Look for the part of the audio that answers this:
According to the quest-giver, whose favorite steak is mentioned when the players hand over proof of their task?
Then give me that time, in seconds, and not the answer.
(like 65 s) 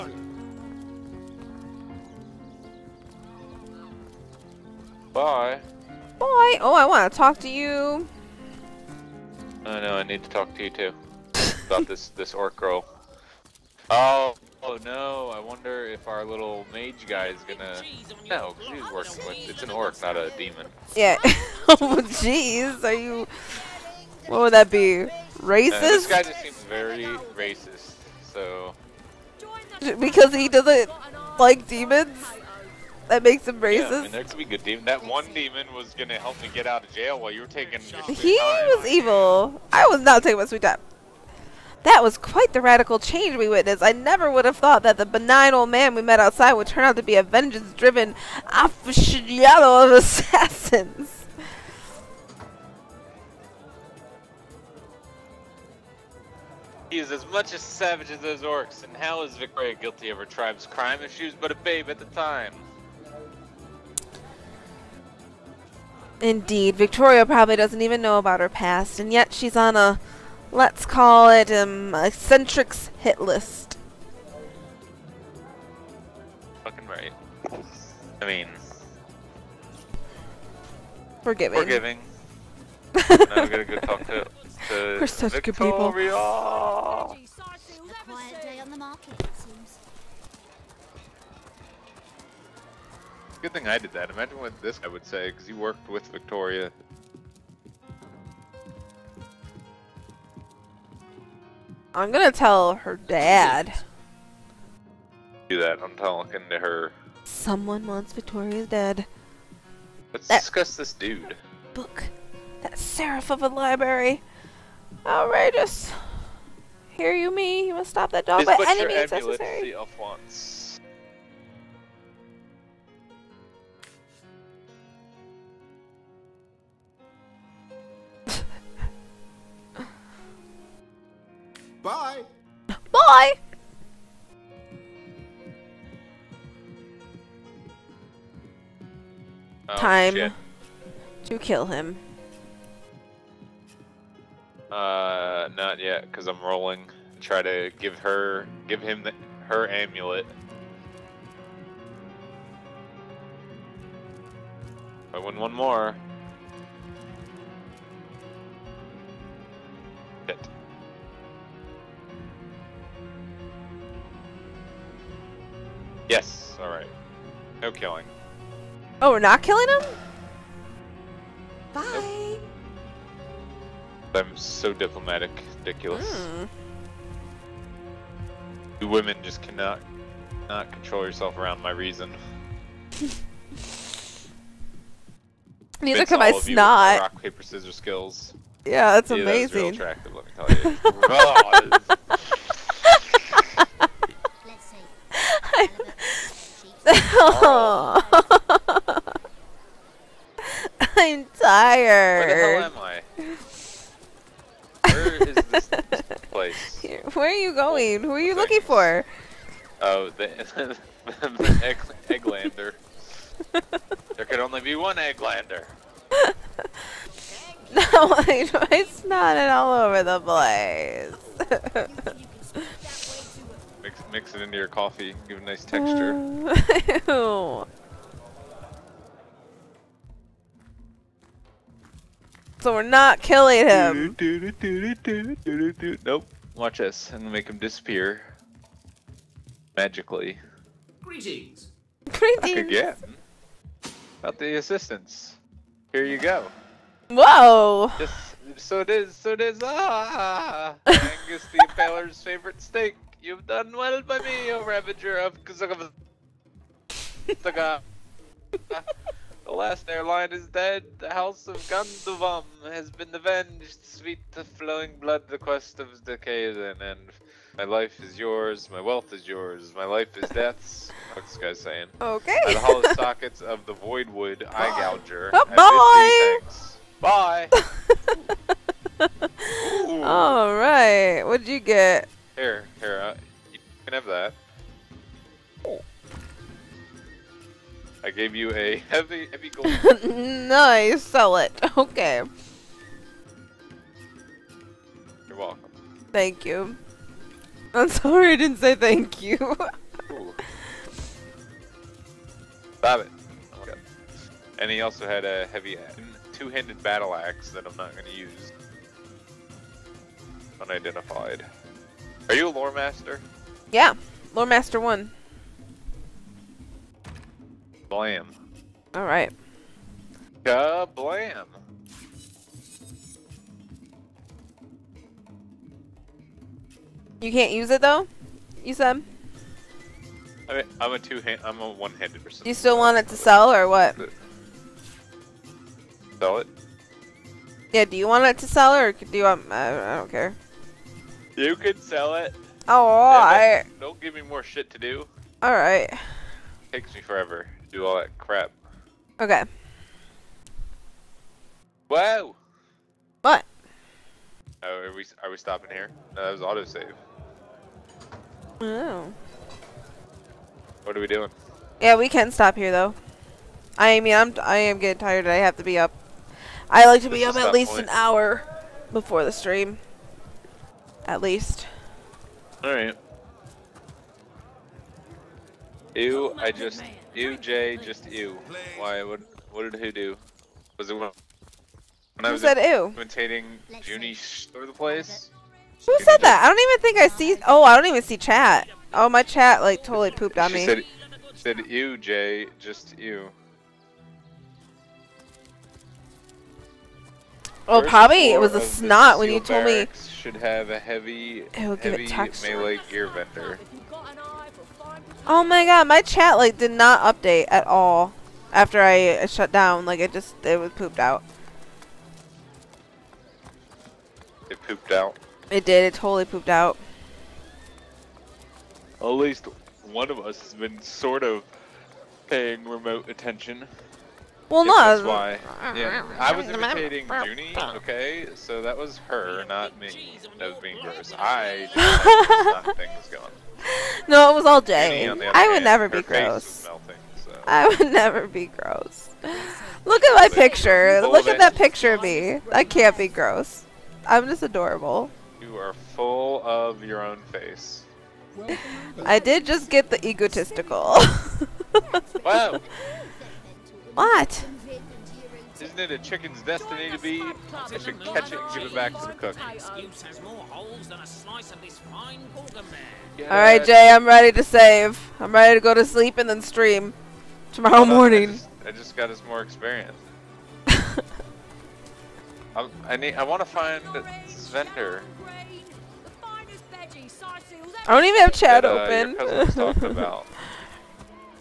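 250 s.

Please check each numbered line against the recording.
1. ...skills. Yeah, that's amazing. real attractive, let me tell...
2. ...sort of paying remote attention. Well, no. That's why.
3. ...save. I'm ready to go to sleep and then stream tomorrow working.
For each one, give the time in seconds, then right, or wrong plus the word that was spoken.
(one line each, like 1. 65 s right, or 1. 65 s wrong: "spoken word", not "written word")
1. 187 s right
2. 420 s right
3. 464 s wrong: "morning", not "working".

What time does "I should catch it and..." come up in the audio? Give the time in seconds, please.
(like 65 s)
457 s.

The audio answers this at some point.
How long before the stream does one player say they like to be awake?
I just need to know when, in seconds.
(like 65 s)
367 s.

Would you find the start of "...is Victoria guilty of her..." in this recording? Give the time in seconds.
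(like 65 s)
59 s.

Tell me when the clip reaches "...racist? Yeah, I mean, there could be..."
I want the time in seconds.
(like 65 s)
33 s.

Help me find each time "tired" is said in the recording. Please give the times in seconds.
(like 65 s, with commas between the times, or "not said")
201 s, 364 s.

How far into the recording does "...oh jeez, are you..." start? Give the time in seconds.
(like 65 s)
21 s.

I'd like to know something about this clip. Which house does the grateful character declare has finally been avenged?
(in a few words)
House of Ganduvam.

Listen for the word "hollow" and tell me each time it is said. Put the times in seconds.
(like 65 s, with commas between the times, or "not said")
272 s.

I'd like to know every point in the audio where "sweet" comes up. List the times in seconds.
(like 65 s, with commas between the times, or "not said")
40 s, 263 s.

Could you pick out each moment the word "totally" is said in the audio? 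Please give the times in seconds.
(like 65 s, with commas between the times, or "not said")
389 s, 415 s.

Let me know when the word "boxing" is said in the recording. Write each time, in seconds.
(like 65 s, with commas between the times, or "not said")
not said.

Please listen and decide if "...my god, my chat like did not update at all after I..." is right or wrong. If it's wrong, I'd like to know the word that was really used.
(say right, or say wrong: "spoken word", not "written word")
right.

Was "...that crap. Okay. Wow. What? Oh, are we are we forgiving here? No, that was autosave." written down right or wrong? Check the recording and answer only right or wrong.
wrong.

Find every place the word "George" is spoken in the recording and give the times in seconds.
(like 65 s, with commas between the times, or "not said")
not said.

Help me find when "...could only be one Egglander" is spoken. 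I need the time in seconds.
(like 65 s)
214 s.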